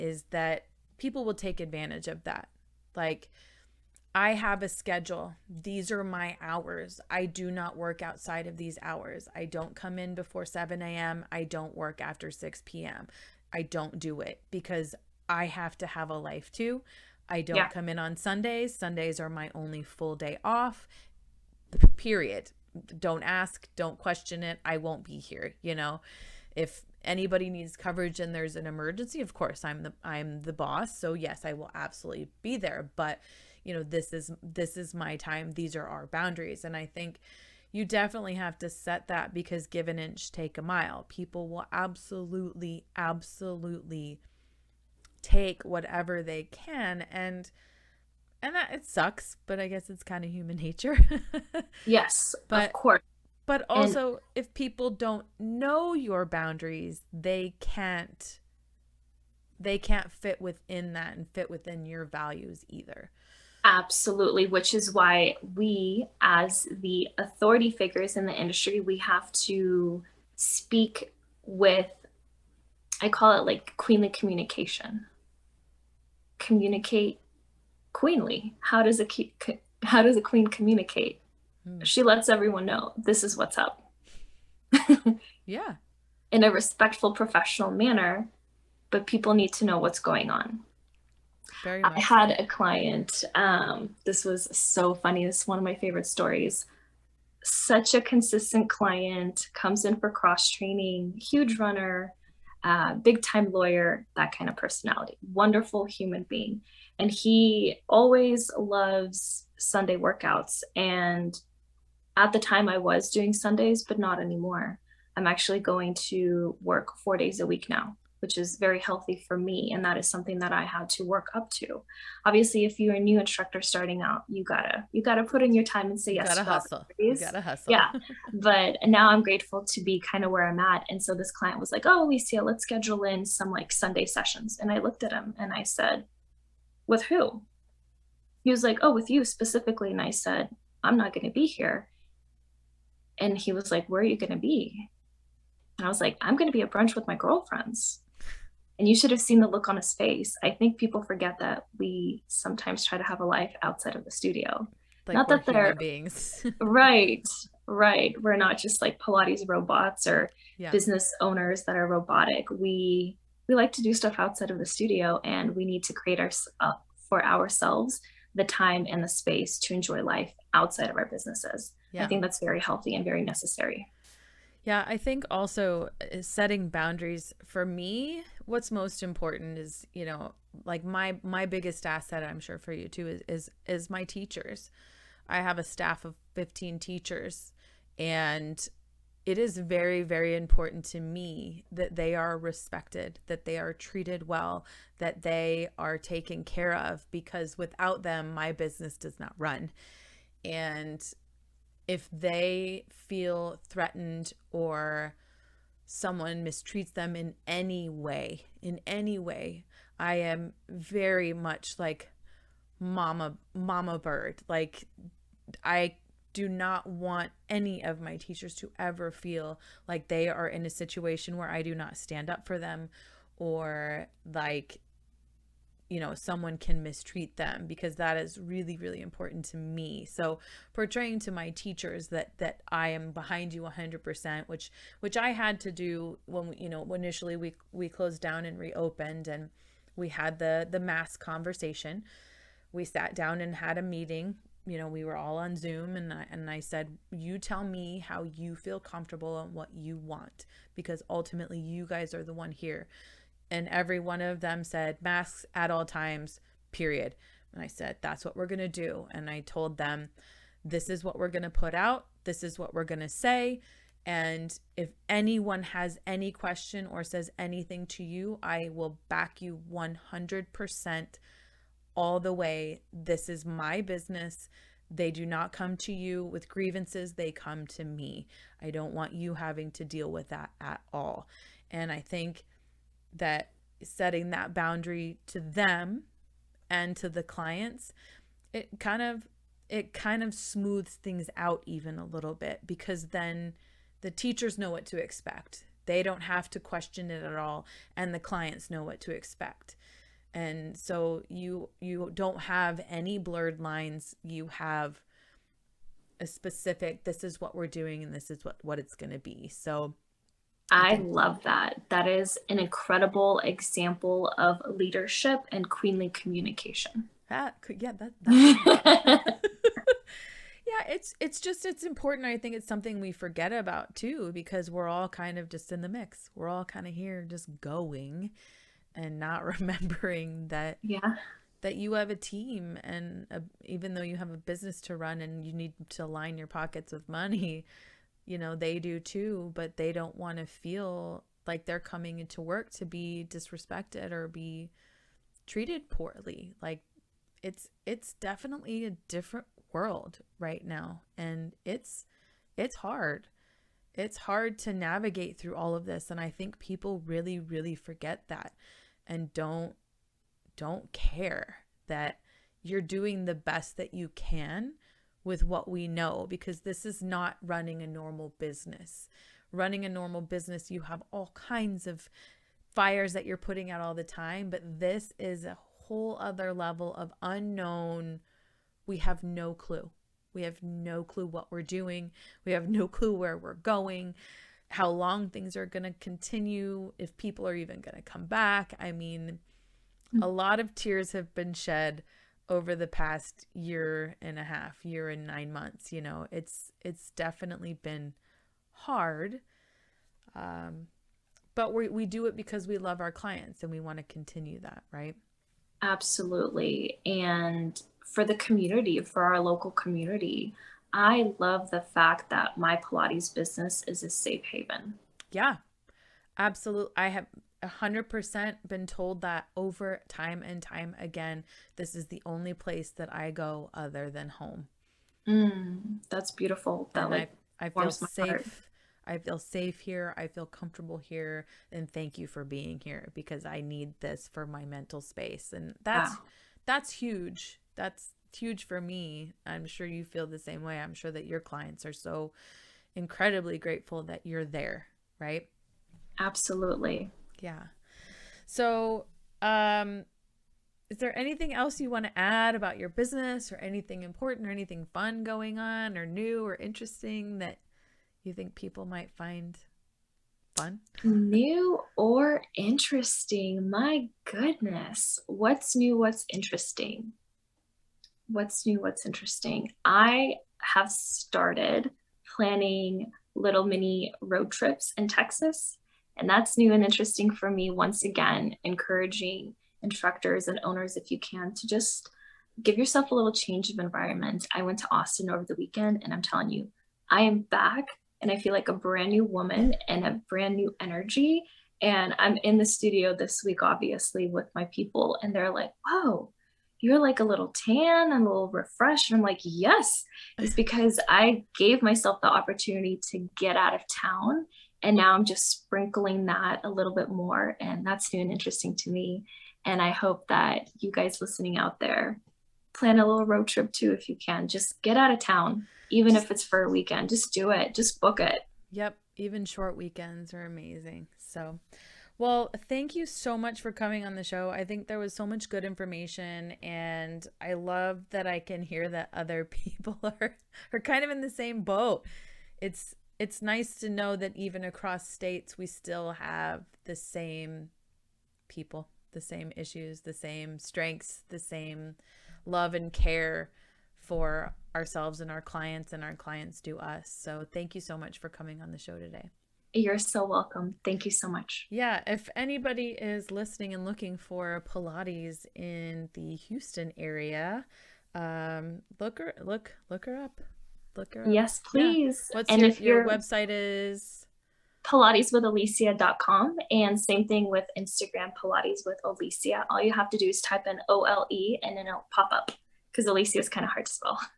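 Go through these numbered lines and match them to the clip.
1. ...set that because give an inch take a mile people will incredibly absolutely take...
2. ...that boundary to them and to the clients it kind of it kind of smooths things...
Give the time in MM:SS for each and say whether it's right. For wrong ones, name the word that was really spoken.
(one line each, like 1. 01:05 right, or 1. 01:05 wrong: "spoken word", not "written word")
1. 00:38 wrong: "absolutely", not "incredibly"
2. 04:44 right.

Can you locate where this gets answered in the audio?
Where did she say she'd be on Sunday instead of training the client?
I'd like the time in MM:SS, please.
02:26.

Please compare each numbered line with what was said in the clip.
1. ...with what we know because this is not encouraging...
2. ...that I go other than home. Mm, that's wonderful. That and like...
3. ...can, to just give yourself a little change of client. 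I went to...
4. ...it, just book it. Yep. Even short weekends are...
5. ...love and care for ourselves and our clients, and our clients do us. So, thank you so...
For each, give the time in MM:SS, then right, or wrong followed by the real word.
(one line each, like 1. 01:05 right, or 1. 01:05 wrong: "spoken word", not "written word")
1. 06:05 wrong: "running", not "encouraging"
2. 07:02 wrong: "beautiful", not "wonderful"
3. 08:01 wrong: "environment", not "client"
4. 08:37 right
5. 09:02 right.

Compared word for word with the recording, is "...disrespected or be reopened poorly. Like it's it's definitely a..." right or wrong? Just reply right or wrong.
wrong.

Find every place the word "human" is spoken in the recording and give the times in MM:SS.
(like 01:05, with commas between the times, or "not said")
00:50, 01:45.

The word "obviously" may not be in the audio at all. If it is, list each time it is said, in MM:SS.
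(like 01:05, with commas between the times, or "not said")
02:02, 08:13.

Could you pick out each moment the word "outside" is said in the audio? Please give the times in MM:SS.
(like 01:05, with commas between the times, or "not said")
00:08, 02:33, 02:44, 02:50.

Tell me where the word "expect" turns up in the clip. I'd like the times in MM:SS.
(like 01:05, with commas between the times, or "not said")
04:54, 04:59.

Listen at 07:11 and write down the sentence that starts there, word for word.
And thank you for being here because I need this for my mental space.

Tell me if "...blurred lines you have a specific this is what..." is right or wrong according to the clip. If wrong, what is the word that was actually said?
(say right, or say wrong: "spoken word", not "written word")
right.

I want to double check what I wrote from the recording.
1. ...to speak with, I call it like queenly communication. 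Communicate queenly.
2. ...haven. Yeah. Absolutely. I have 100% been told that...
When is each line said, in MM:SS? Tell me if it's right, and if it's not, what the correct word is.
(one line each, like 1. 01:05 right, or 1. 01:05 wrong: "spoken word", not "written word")
1. 01:09 right
2. 06:54 right.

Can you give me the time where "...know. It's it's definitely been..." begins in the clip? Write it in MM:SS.
06:36.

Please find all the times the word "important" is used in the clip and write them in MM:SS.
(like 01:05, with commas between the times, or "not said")
02:59, 03:10, 03:49, 05:21, 07:34.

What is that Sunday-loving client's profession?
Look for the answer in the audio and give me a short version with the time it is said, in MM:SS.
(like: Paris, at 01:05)
lawyer, at 01:43.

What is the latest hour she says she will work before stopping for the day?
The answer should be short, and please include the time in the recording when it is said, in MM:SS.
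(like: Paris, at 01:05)
6 p.m., at 00:12.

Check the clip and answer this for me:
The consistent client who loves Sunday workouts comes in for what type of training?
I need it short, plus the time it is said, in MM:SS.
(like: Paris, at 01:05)
cross training, at 01:40.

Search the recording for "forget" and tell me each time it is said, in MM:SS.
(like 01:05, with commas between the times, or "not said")
02:31, 05:23, 05:57.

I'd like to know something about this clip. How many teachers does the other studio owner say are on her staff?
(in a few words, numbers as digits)
15.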